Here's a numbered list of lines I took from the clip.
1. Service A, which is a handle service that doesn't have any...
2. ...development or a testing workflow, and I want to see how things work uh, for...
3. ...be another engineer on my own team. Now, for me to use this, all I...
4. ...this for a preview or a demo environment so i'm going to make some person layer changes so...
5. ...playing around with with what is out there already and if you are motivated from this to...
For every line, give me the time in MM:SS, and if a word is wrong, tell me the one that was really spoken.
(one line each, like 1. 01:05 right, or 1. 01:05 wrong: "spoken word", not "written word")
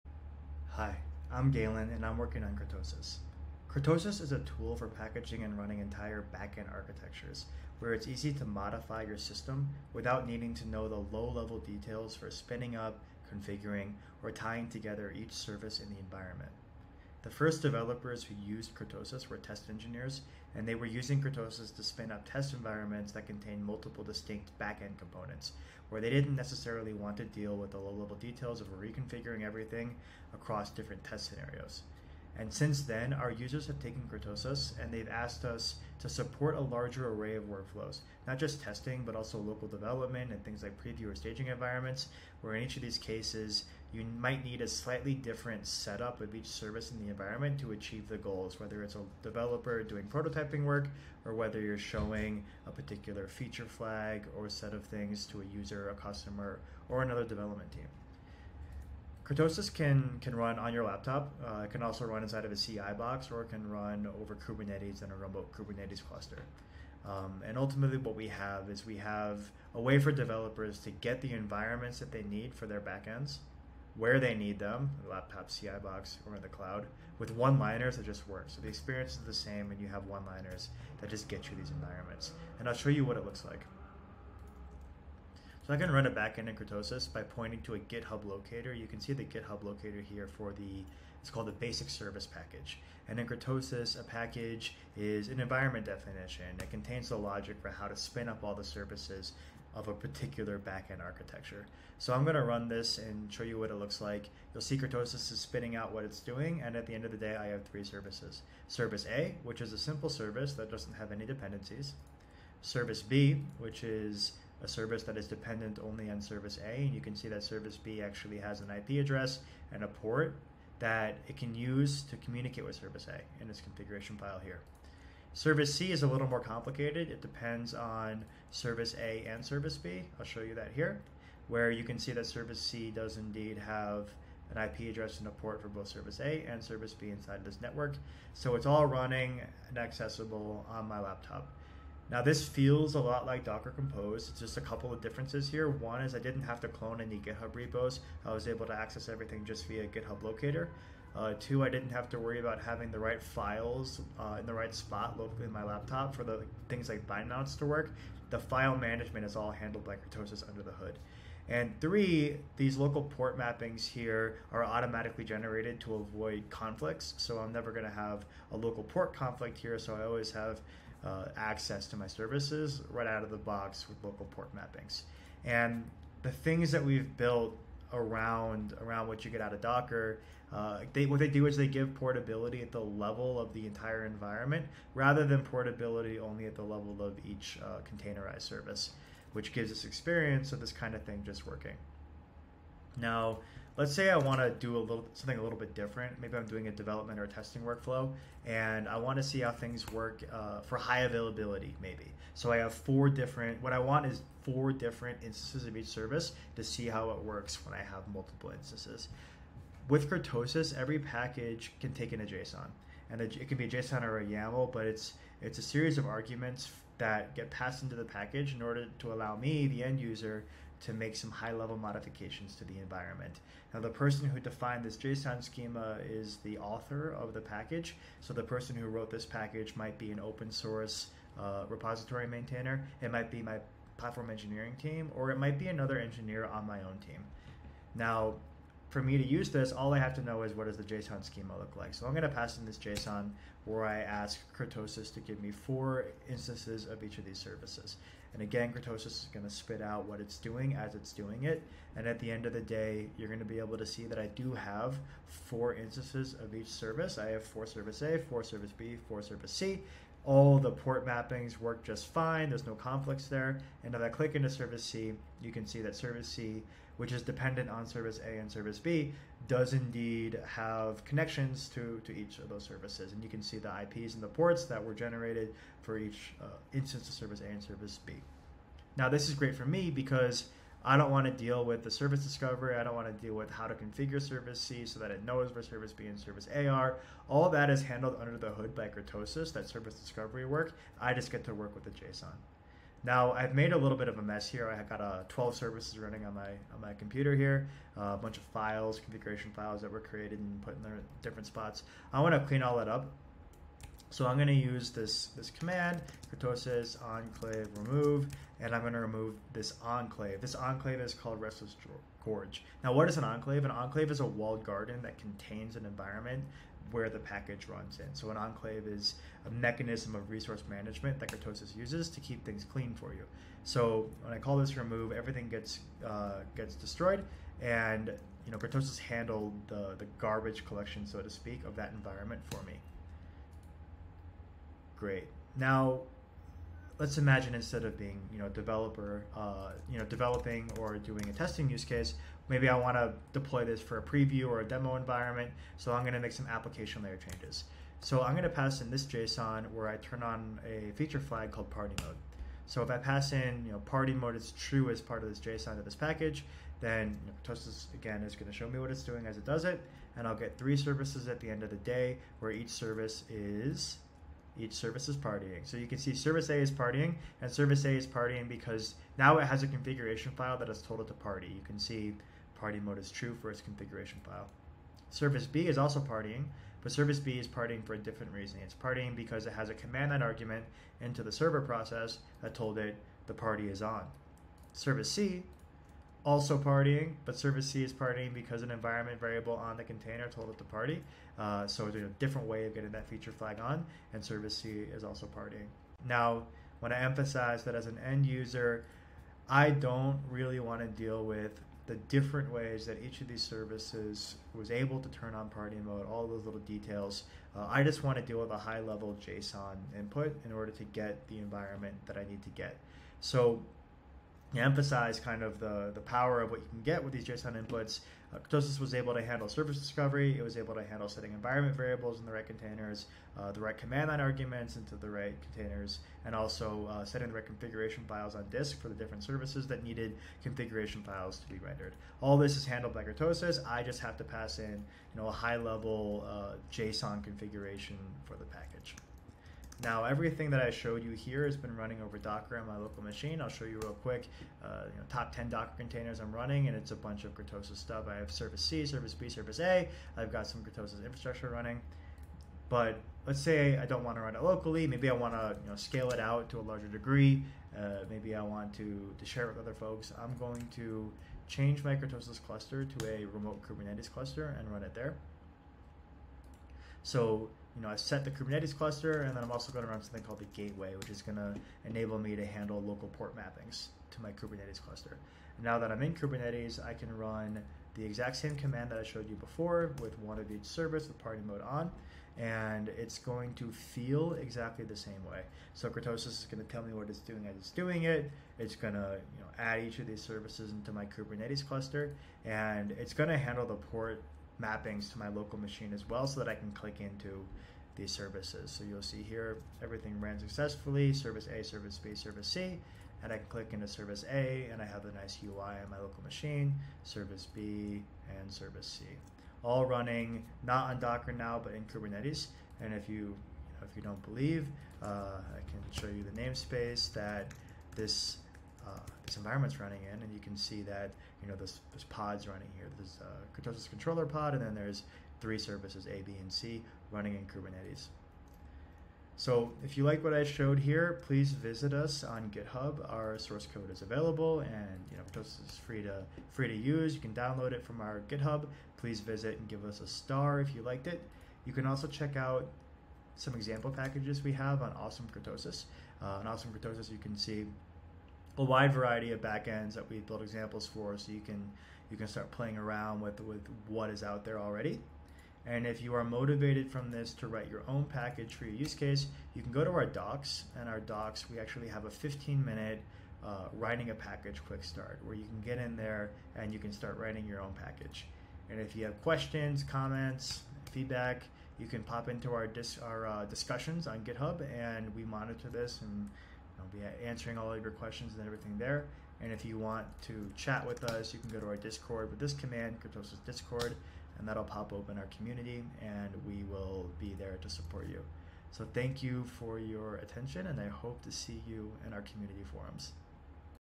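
1. 01:48 wrong: "simple", not "handle"
2. 03:16 right
3. 03:55 right
4. 05:43 wrong: "application", not "person"
5. 09:12 right.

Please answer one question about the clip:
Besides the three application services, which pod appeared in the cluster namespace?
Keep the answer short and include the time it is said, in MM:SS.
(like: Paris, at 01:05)
Kurtosis controller pod, at 08:43.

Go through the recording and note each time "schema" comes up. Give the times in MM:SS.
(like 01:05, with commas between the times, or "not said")
03:45, 04:01.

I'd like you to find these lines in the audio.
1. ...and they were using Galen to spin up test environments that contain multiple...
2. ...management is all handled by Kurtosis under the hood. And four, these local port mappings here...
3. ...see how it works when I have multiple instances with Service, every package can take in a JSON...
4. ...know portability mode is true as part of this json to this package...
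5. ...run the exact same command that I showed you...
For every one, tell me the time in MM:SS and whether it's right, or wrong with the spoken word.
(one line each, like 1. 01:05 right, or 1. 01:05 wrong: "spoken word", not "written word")
1. 00:20 wrong: "Kurtosis", not "Galen"
2. 02:38 wrong: "three", not "four"
3. 03:26 wrong: "Kurtosis", not "Service"
4. 05:53 wrong: "party", not "portability"
5. 07:57 right.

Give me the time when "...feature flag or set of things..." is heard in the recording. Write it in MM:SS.
00:53.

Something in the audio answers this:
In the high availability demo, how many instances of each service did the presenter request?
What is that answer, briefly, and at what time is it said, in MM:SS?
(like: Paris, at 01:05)
4, at 04:05.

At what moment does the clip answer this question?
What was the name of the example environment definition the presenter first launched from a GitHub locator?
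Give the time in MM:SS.
01:31.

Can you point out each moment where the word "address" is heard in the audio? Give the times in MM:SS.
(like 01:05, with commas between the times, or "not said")
01:59, 02:14.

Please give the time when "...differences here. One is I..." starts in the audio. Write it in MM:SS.
02:25.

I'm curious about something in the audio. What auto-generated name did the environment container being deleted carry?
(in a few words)
Restless Gorge.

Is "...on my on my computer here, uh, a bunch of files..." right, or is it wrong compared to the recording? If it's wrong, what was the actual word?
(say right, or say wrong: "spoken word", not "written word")
right.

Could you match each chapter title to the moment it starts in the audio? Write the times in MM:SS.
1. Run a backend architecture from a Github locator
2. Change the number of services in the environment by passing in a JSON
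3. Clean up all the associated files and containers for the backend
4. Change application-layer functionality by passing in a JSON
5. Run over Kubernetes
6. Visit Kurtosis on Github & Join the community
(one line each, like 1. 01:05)
1. 01:24
2. 03:12
3. 04:53
4. 05:35
5. 07:19
6. 08:49.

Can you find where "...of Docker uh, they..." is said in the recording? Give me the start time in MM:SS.
02:59.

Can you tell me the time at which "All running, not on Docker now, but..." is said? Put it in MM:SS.
08:29.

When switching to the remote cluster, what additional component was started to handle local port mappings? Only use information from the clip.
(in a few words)
the gateway.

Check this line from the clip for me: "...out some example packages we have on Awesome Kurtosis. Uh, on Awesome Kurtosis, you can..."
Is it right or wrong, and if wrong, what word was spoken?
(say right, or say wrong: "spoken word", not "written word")
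right.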